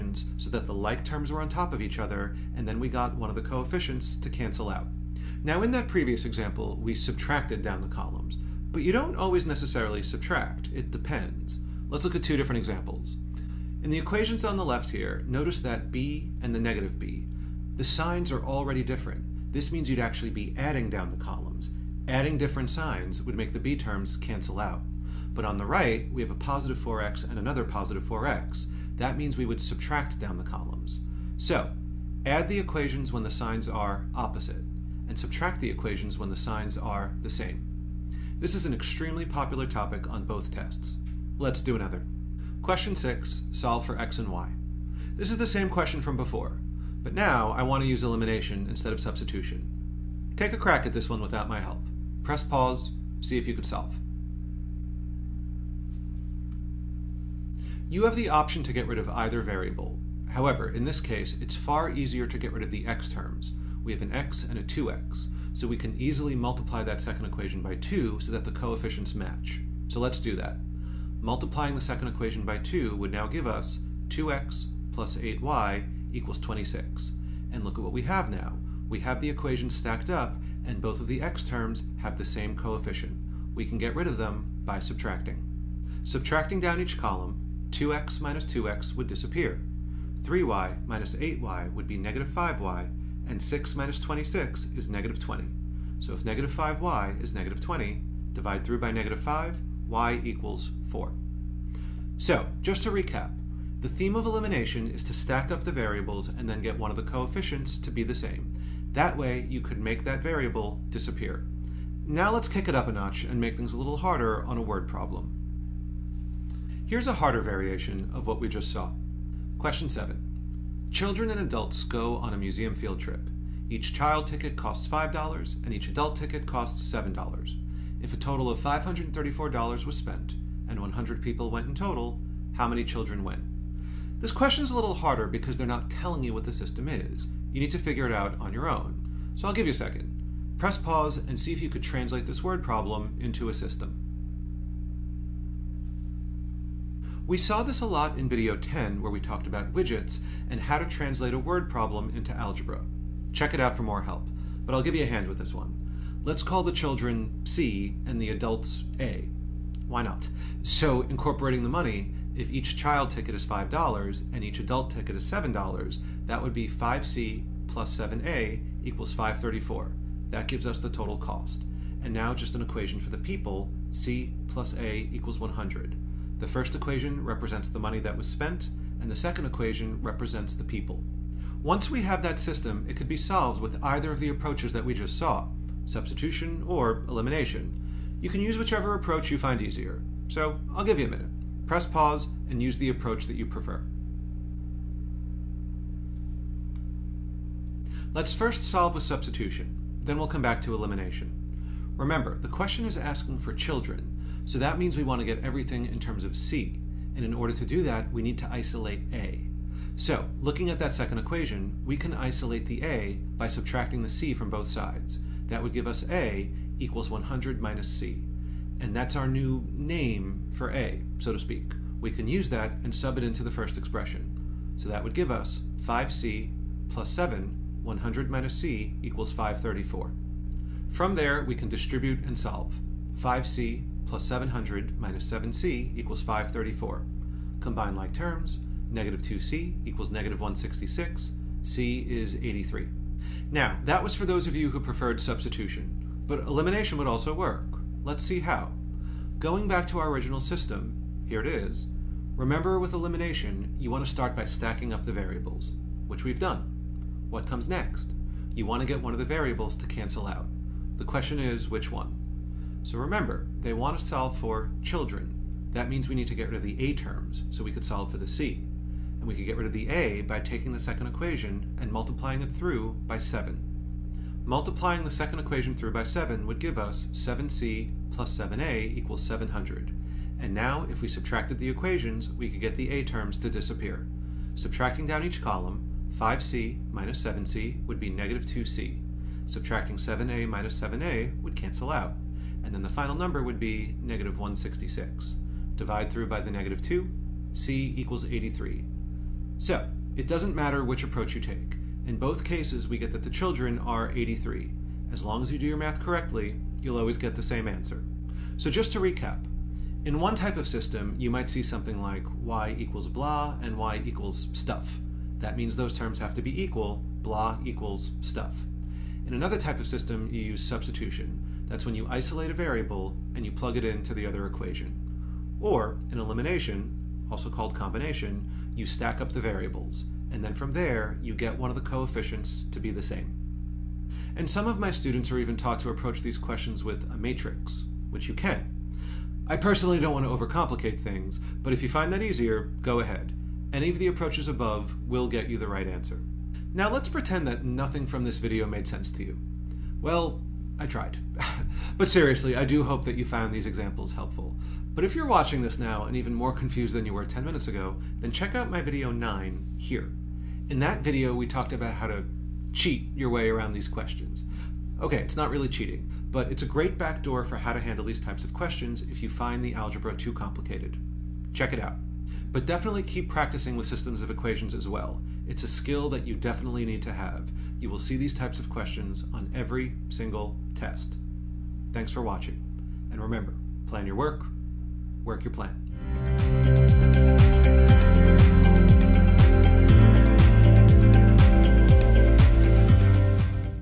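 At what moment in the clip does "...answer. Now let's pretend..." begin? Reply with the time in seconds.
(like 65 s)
345 s.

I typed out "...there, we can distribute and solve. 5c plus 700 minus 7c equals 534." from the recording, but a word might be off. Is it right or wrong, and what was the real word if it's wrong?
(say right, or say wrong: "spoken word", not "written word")
right.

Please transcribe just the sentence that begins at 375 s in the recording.
It's a skill that you definitely need to have.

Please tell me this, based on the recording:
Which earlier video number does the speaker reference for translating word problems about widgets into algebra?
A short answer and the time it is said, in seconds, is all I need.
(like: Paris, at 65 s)
10, at 148 s.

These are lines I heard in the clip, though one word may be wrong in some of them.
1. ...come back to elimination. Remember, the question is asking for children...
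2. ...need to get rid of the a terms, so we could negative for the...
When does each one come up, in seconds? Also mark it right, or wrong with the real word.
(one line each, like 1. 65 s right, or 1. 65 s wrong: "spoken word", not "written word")
1. 200 s right
2. 266 s wrong: "solve", not "negative".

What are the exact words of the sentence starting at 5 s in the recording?
Now in that previous example, we subtracted down the columns, but you don't always necessarily subtract, it depends.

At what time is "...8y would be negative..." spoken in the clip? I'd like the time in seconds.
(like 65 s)
91 s.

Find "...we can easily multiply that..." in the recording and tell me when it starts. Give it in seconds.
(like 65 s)
65 s.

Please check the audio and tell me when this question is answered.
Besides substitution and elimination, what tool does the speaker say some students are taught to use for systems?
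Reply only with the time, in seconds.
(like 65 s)
337 s.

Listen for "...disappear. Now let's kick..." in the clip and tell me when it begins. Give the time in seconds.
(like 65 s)
110 s.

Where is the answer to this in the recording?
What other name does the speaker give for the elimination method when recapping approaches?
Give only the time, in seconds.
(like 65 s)
327 s.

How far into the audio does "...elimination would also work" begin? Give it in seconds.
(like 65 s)
246 s.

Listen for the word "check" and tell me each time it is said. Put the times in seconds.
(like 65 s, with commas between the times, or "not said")
153 s, 358 s, 371 s.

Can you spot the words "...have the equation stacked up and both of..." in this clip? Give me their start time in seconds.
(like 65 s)
78 s.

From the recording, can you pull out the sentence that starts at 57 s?
You have the option to get rid of either variable.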